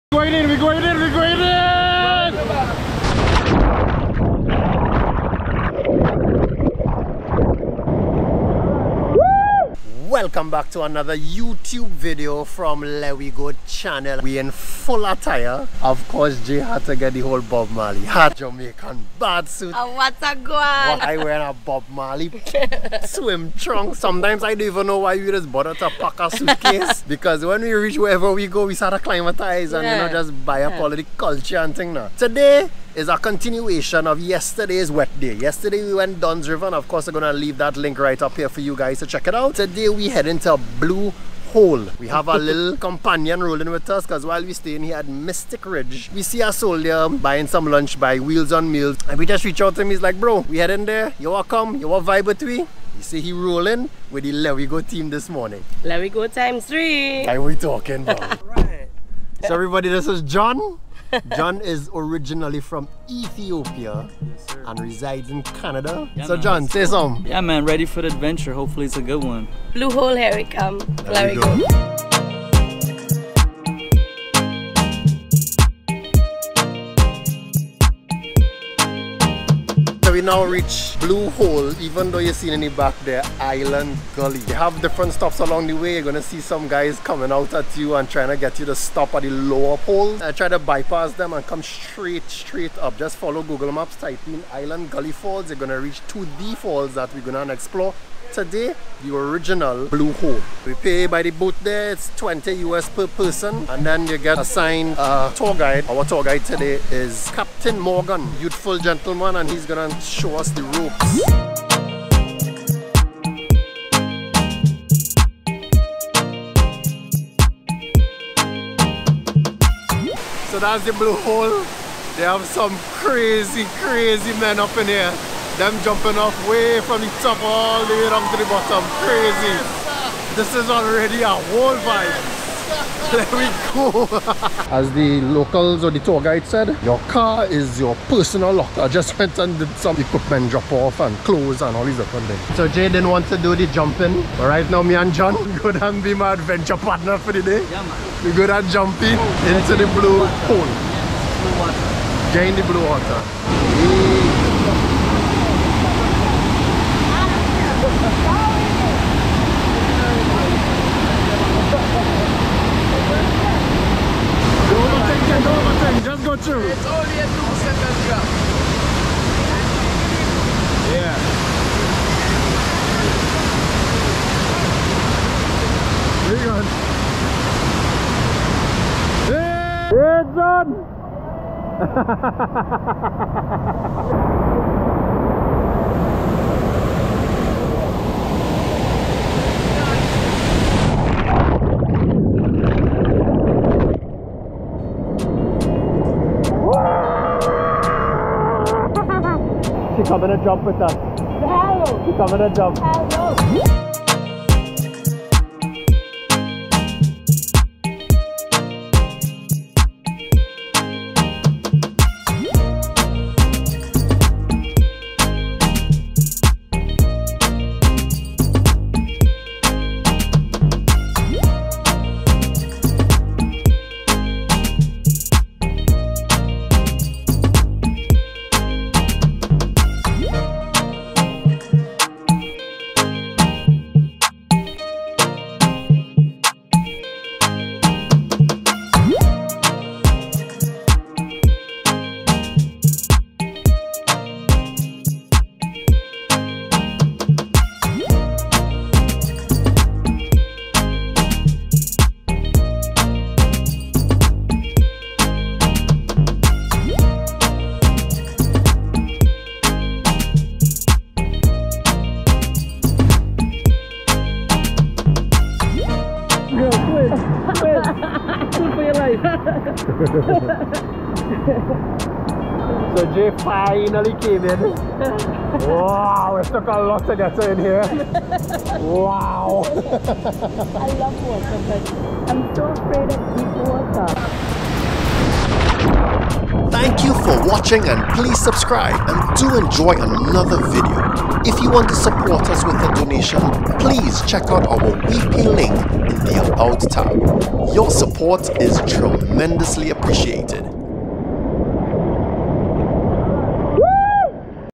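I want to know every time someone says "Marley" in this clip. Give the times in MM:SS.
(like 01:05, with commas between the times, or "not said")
00:17, 00:21.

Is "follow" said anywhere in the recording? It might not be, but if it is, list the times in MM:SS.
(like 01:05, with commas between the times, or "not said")
01:33.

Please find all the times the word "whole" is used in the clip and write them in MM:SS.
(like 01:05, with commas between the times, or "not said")
00:17, 02:11.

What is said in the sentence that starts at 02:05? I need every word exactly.
Them jumping off way from the top all the way down to the bottom.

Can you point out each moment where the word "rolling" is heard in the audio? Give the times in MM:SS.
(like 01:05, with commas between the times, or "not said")
00:43, 00:53.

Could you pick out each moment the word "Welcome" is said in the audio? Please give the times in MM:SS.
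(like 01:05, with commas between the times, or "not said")
00:10.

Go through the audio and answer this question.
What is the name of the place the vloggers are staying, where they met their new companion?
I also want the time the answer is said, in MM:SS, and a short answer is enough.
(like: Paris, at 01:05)
Mystic Ridge, at 00:45.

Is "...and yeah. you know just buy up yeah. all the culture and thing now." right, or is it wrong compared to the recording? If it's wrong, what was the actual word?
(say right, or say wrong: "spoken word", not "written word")
right.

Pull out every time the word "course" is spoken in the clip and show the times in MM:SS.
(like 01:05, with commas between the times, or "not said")
00:16, 00:36.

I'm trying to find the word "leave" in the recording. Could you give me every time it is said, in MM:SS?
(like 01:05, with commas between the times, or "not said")
00:37.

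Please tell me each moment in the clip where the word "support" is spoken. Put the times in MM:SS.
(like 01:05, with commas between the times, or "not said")
04:51, 04:57.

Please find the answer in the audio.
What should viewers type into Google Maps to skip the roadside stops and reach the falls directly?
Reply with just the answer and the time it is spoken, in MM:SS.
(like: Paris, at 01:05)
Island Gully Falls, at 01:34.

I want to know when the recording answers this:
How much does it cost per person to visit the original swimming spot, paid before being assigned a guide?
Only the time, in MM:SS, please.
01:42.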